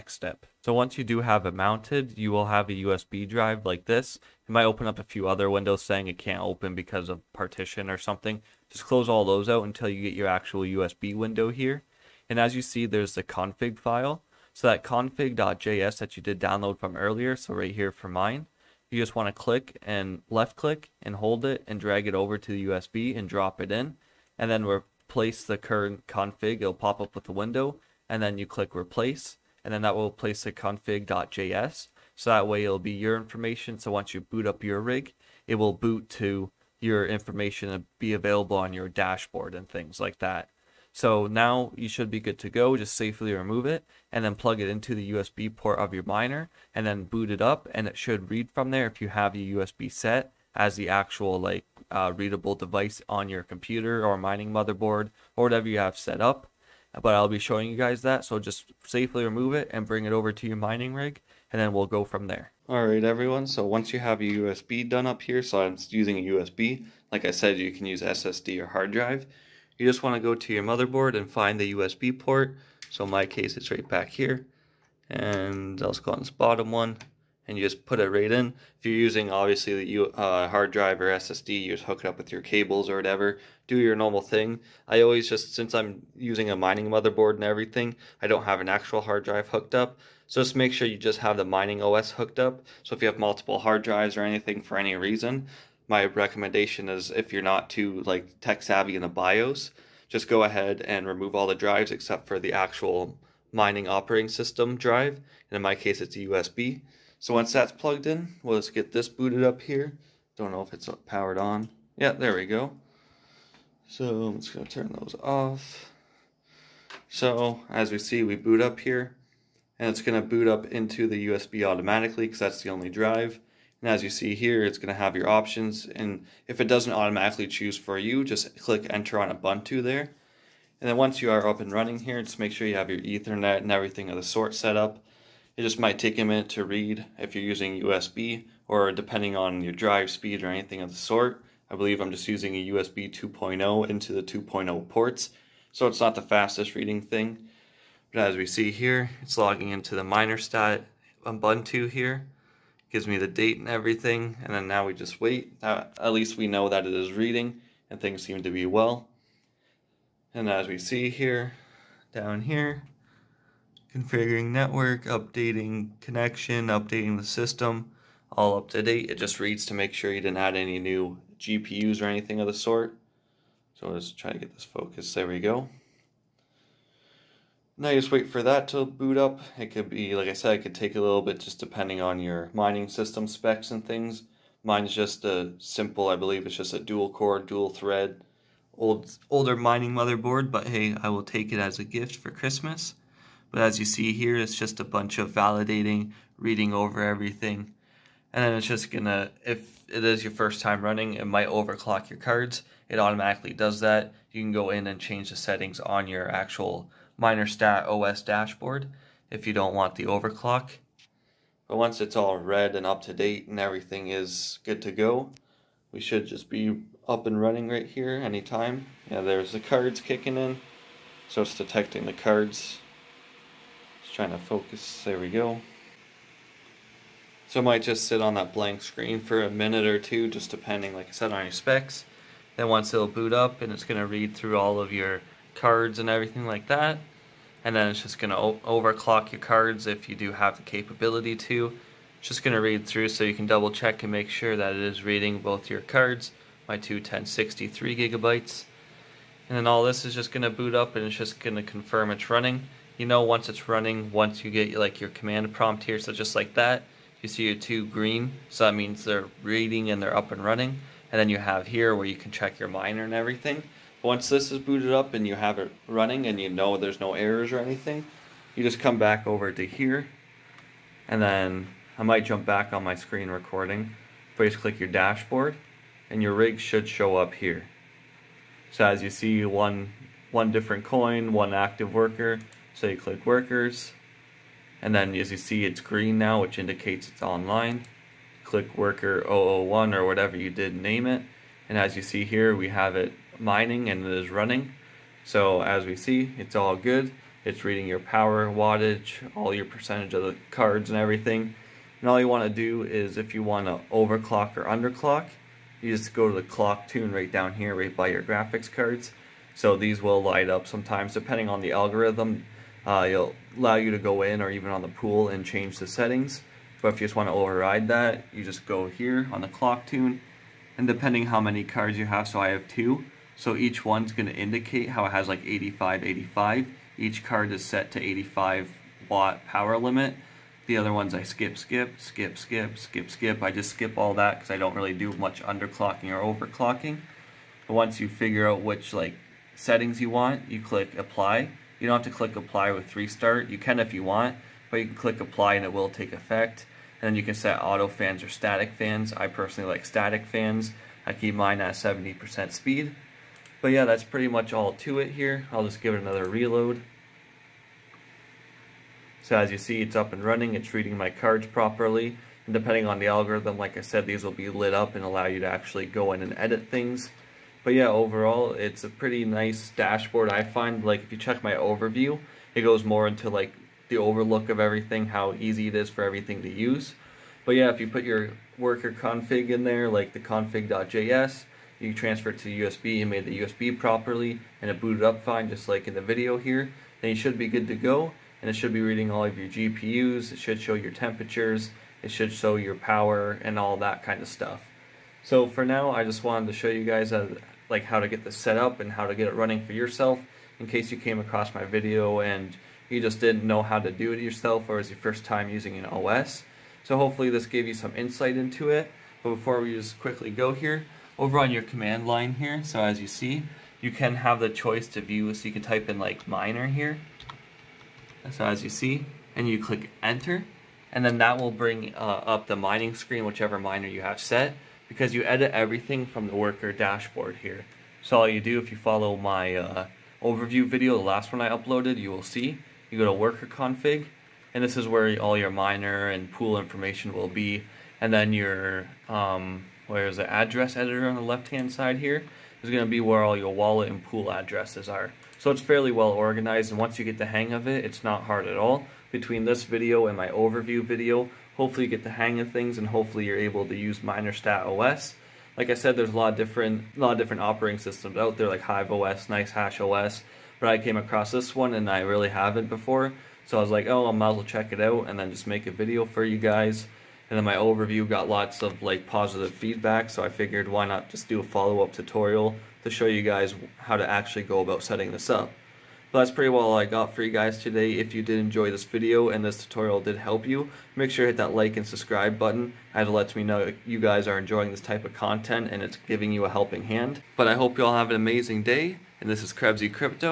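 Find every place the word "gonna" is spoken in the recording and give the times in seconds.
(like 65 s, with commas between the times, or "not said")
114 s, 120 s, 198 s.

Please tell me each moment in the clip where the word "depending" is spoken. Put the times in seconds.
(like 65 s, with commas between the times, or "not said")
138 s, 181 s, 230 s, 311 s, 320 s, 362 s.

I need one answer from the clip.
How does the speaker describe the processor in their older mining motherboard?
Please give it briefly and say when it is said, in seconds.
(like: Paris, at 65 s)
dual core, dual thread, at 186 s.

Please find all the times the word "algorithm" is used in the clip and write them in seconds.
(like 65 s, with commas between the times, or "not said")
311 s, 363 s.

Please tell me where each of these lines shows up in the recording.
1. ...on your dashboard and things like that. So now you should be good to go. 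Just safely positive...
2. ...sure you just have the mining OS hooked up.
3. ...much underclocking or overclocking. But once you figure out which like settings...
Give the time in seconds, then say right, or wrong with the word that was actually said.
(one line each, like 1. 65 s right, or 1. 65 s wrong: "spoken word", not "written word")
1. 38 s wrong: "remove", not "positive"
2. 90 s right
3. 335 s right.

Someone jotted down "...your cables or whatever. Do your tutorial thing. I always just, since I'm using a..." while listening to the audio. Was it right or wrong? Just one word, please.
wrong.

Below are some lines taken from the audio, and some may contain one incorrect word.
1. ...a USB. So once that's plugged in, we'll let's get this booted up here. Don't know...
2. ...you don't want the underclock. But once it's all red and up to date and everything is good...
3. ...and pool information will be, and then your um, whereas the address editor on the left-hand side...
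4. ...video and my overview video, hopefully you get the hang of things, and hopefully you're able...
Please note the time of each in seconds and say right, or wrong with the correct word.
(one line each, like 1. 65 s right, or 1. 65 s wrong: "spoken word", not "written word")
1. 106 s right
2. 209 s wrong: "overclock", not "underclock"
3. 436 s right
4. 449 s right.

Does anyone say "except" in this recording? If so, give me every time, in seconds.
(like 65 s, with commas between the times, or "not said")
101 s.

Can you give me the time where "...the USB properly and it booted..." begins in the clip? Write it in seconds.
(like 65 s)
383 s.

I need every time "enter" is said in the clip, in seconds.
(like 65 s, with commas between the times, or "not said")
128 s, 420 s.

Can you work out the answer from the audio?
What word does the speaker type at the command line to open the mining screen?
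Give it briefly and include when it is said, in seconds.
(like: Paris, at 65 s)
minor, at 416 s.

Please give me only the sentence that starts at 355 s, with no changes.
I'll just give it another reload.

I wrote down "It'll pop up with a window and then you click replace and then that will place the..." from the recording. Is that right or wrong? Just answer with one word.
right.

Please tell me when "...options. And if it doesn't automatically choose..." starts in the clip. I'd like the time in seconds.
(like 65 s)
125 s.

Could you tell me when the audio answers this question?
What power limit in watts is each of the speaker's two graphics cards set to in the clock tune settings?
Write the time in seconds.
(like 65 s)
328 s.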